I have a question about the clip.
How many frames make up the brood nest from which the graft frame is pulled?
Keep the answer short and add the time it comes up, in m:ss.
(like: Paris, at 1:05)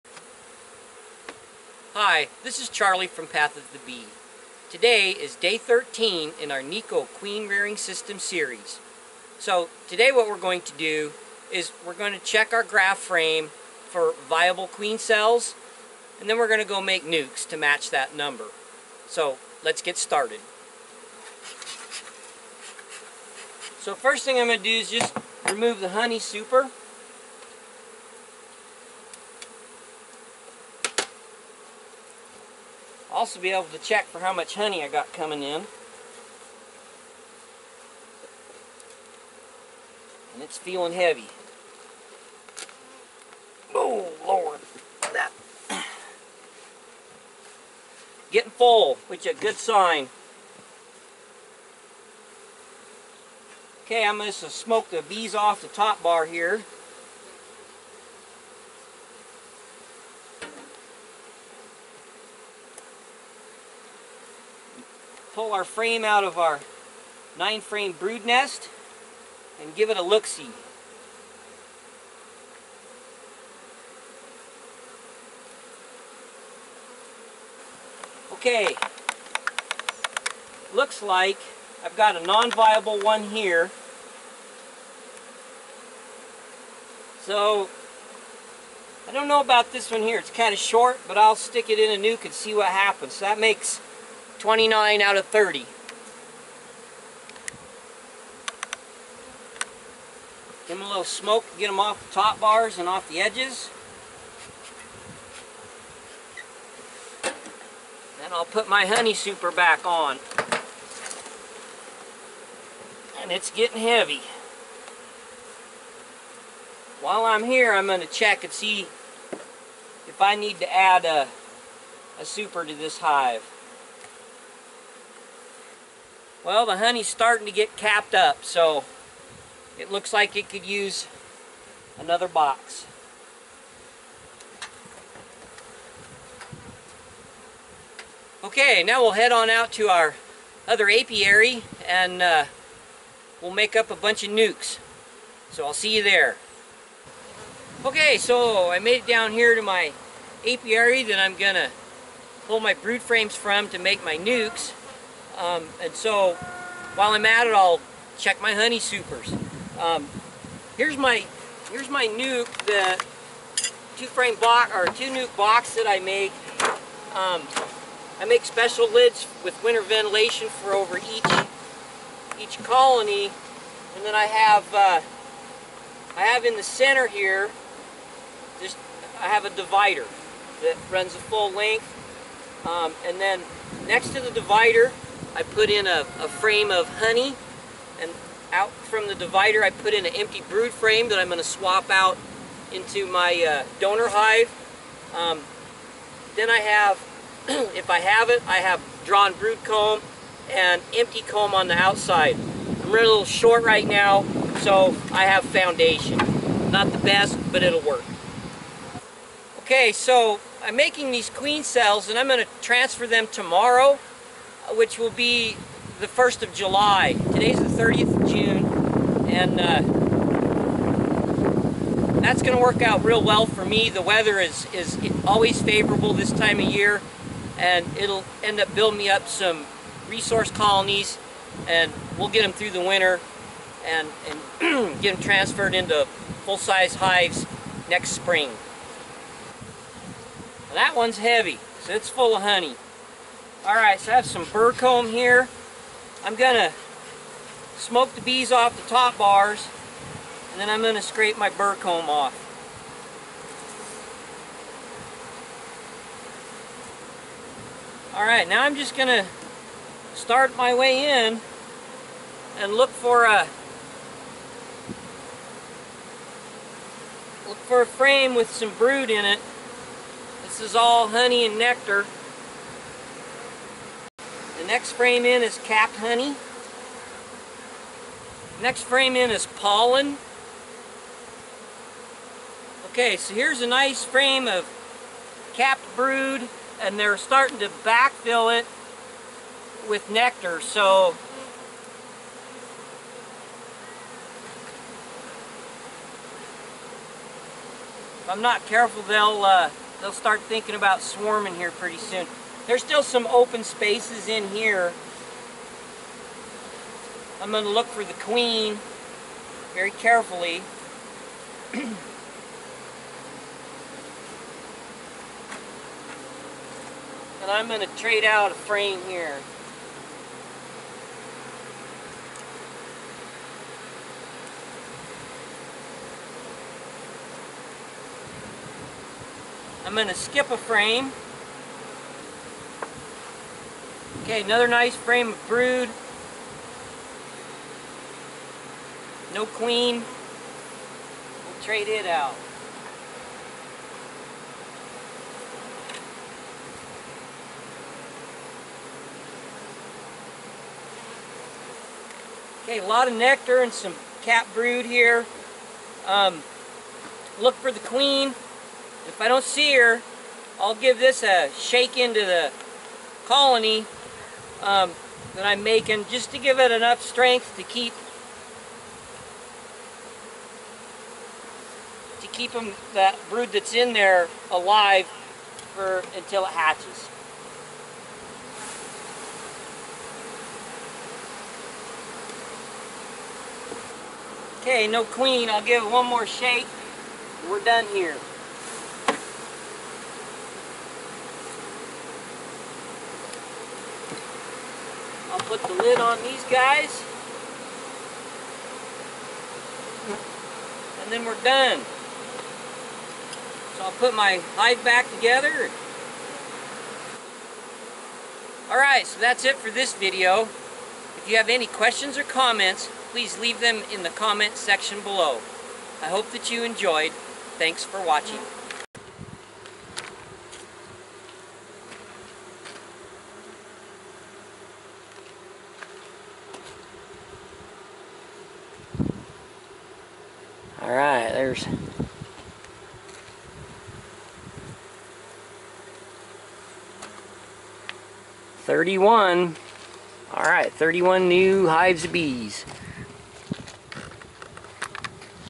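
9, at 1:07.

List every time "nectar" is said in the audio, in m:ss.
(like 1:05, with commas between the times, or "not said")
4:31, 4:50, 5:53.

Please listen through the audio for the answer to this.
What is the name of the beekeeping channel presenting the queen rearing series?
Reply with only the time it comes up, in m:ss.
0:03.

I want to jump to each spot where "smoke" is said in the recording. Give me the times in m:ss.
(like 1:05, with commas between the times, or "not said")
0:54, 1:41, 4:07.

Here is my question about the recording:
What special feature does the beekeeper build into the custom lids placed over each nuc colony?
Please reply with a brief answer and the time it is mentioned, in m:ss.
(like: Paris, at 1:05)
Winter ventilation, at 2:49.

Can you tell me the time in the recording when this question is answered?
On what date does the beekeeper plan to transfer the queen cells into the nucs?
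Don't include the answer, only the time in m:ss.
3:36.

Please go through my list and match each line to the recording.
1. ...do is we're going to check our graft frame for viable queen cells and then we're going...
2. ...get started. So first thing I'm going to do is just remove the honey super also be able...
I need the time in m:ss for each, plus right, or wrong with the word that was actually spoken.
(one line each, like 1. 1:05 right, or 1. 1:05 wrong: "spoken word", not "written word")
1. 0:10 right
2. 0:19 right.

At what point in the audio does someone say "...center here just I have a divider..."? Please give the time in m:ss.
2:56.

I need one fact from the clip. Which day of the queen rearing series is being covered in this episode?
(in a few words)
13.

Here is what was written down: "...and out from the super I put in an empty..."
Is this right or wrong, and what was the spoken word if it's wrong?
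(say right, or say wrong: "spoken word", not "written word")
wrong: "divider", not "super".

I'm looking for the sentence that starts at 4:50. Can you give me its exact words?
So if I'm not careful, they'll uh, they'll start thinking about swarming here pretty soon.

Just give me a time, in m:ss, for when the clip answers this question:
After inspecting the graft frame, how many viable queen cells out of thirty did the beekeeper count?
1:34.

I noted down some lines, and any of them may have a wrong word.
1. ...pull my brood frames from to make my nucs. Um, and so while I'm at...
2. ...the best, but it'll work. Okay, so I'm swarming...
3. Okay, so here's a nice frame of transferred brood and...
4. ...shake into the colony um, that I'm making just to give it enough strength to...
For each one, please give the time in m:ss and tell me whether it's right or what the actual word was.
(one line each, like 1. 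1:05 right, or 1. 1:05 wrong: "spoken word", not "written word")
1. 2:32 right
2. 3:26 wrong: "making", not "swarming"
3. 4:42 wrong: "capped", not "transferred"
4. 6:01 right.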